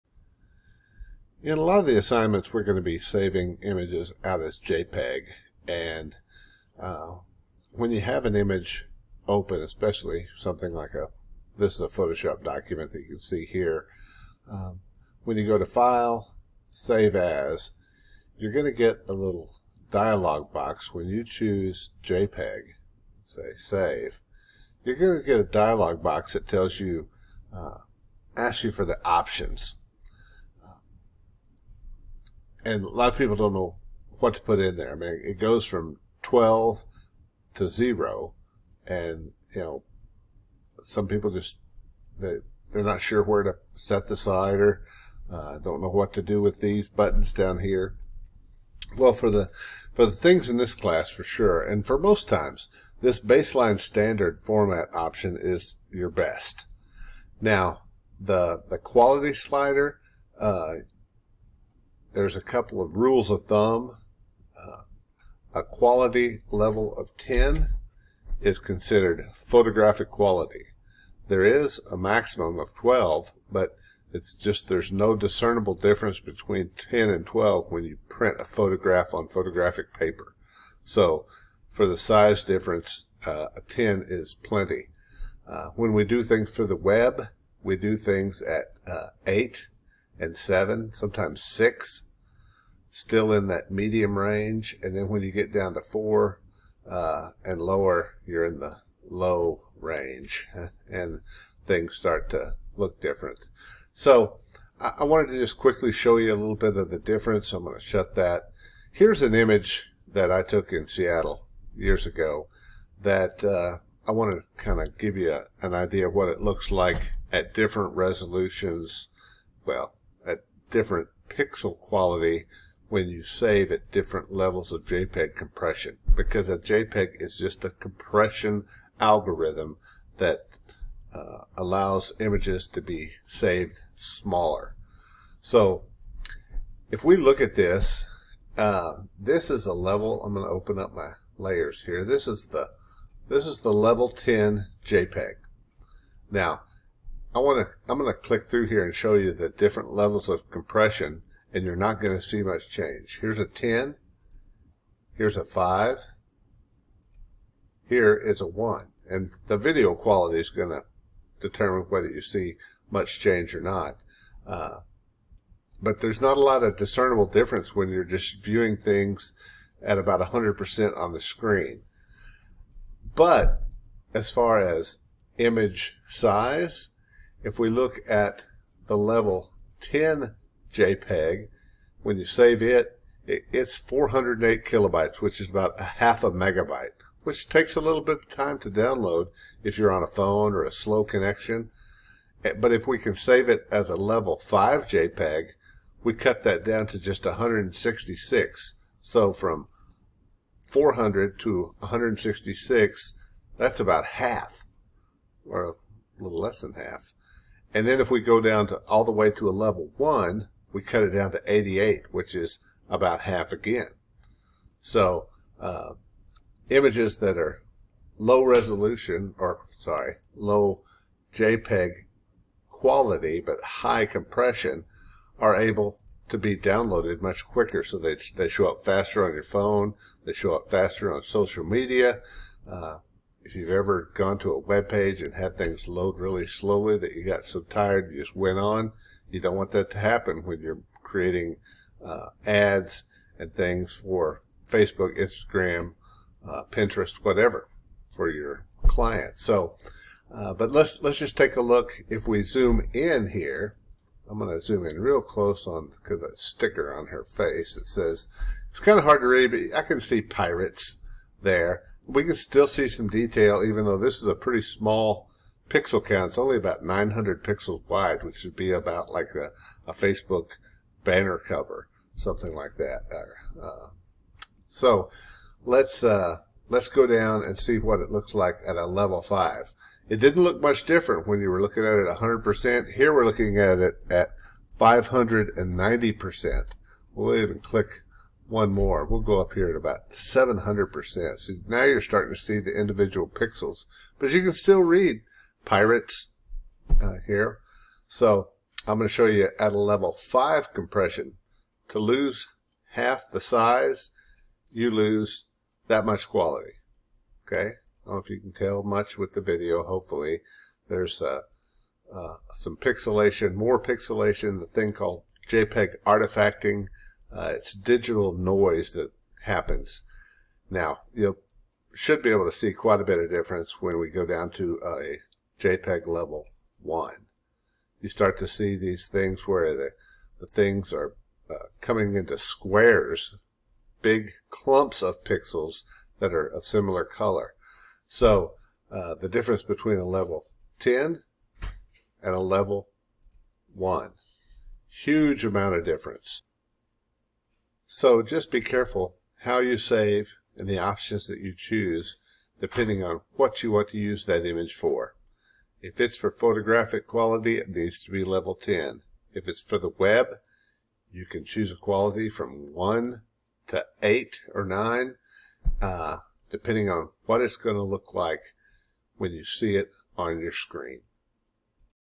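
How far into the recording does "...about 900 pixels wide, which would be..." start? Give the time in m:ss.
4:26.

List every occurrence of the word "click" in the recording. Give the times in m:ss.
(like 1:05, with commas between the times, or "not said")
2:28, 4:47.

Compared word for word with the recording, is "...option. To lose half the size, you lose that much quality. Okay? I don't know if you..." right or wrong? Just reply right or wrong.
wrong.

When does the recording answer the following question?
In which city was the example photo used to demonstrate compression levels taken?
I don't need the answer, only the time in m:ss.
1:50.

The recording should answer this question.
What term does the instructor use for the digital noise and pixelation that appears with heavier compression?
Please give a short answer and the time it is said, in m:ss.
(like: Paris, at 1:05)
JPEG artifacting, at 5:15.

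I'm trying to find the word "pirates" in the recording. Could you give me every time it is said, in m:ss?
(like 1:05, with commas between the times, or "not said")
4:20, 4:55.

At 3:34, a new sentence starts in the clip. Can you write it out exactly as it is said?
So uh, images that are low resolution, or sorry, low JPEG quality, but high compression, are able to be downloaded much quicker.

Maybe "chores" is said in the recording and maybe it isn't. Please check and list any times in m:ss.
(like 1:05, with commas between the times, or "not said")
not said.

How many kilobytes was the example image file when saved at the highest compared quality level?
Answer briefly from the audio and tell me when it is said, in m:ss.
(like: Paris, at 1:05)
408 kilobytes, at 3:03.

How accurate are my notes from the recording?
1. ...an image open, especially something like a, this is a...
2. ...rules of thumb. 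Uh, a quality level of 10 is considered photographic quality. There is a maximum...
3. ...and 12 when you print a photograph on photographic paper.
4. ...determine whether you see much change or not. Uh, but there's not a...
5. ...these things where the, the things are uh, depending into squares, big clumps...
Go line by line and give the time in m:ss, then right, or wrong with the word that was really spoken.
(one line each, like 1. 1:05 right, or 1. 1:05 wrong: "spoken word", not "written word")
1. 0:08 right
2. 1:02 right
3. 1:17 right
4. 2:41 right
5. 5:28 wrong: "coming", not "depending".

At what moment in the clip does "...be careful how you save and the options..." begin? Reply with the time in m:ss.
5:48.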